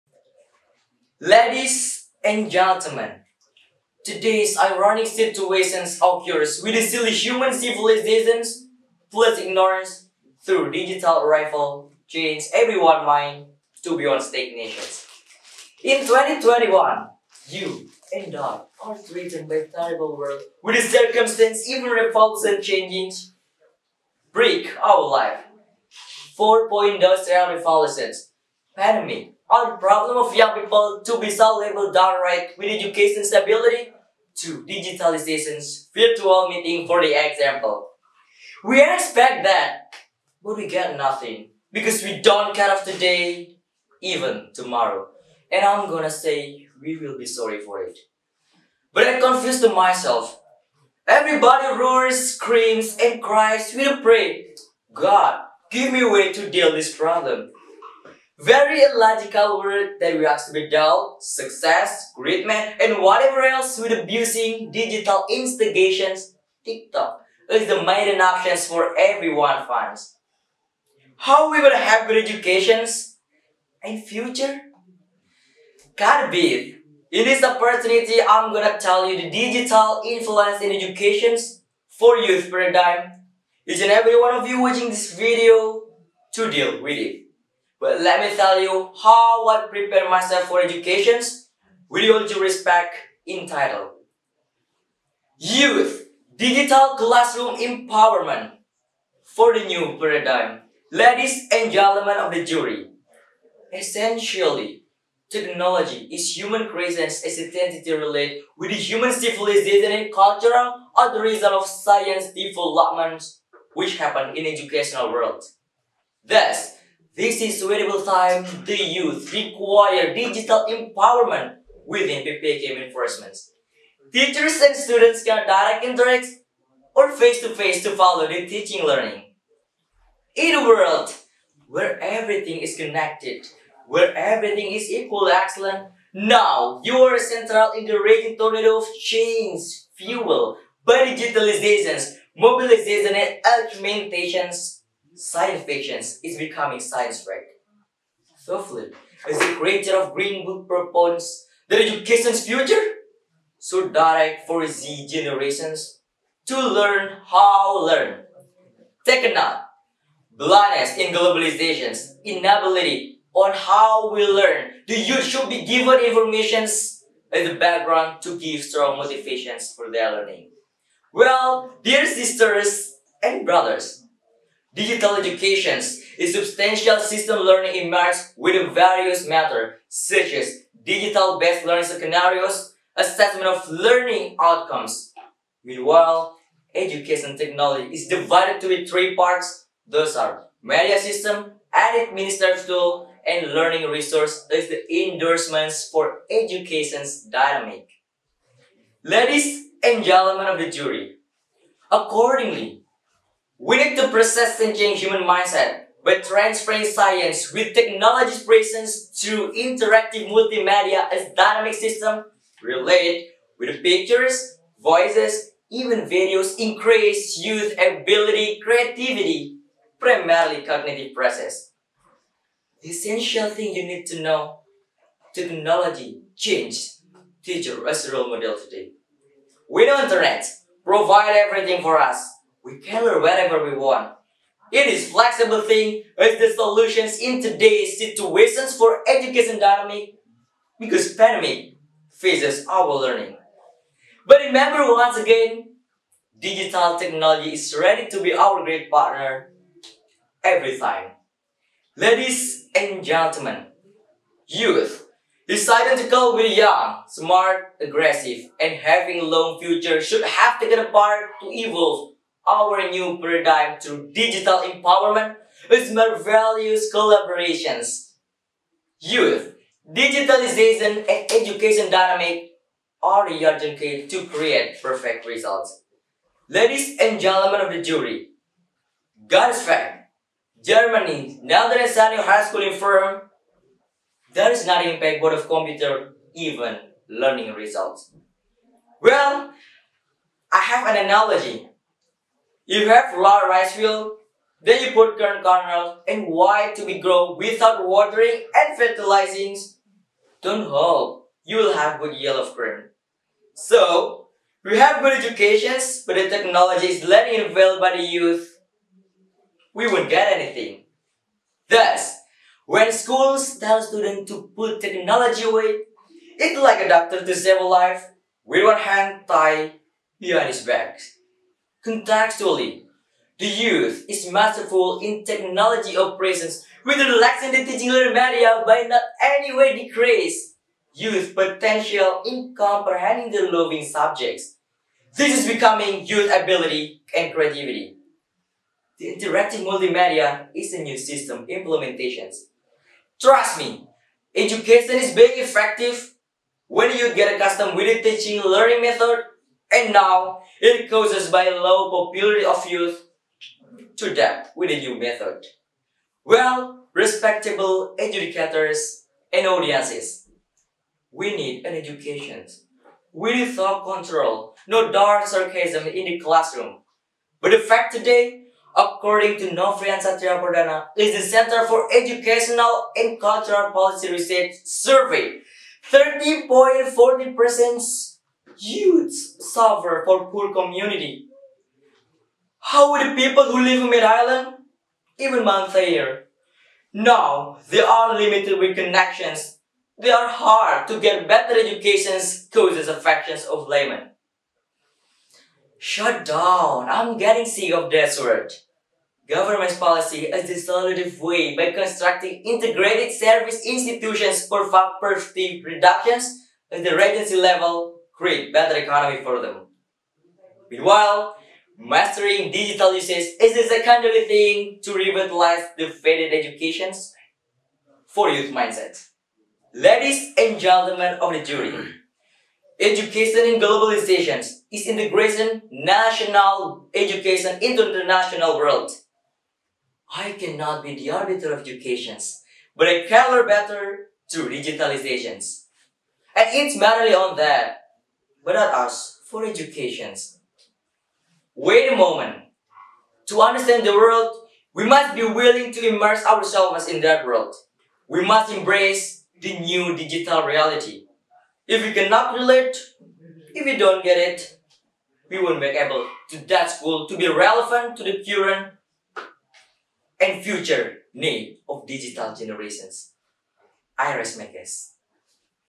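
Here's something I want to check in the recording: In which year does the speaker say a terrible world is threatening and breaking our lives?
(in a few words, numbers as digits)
2021.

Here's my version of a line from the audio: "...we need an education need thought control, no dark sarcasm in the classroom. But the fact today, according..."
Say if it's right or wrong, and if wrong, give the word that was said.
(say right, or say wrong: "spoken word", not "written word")
right.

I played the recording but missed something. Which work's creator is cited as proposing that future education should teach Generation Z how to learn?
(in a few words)
Green Book.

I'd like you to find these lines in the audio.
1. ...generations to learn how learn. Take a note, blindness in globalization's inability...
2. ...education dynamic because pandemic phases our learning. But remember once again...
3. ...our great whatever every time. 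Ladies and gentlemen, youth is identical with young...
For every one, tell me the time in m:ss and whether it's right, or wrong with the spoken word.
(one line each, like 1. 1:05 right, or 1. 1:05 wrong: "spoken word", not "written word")
1. 2:35 right
2. 3:59 right
3. 4:08 wrong: "partner", not "whatever".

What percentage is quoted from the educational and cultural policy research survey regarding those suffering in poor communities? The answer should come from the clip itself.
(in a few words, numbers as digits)
30.40%.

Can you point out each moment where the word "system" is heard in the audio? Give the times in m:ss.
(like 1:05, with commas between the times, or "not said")
2:57, 3:10, 3:31, 5:40.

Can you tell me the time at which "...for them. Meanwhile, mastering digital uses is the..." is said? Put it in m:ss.
6:49.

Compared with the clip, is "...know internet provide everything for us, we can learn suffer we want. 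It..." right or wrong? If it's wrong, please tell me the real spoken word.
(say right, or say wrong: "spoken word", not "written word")
wrong: "whatever", not "suffer".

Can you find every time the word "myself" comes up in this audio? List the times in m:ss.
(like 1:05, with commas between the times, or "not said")
0:49, 1:30.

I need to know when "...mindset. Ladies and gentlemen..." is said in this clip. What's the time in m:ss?
6:58.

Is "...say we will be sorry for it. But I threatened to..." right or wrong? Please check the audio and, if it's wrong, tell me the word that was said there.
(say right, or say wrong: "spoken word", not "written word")
wrong: "confused", not "threatened".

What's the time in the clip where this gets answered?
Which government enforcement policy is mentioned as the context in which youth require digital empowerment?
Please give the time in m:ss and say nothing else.
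2:02.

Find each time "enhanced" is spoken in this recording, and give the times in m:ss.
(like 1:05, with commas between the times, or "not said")
not said.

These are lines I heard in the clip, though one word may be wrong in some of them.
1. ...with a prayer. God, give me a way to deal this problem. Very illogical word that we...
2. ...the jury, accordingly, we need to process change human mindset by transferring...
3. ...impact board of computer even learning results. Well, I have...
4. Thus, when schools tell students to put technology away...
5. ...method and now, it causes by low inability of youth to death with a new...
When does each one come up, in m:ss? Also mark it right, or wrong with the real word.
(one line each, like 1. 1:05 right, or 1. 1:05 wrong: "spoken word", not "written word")
1. 0:53 right
2. 3:20 right
3. 4:44 right
4. 5:11 right
5. 5:48 wrong: "popularity", not "inability".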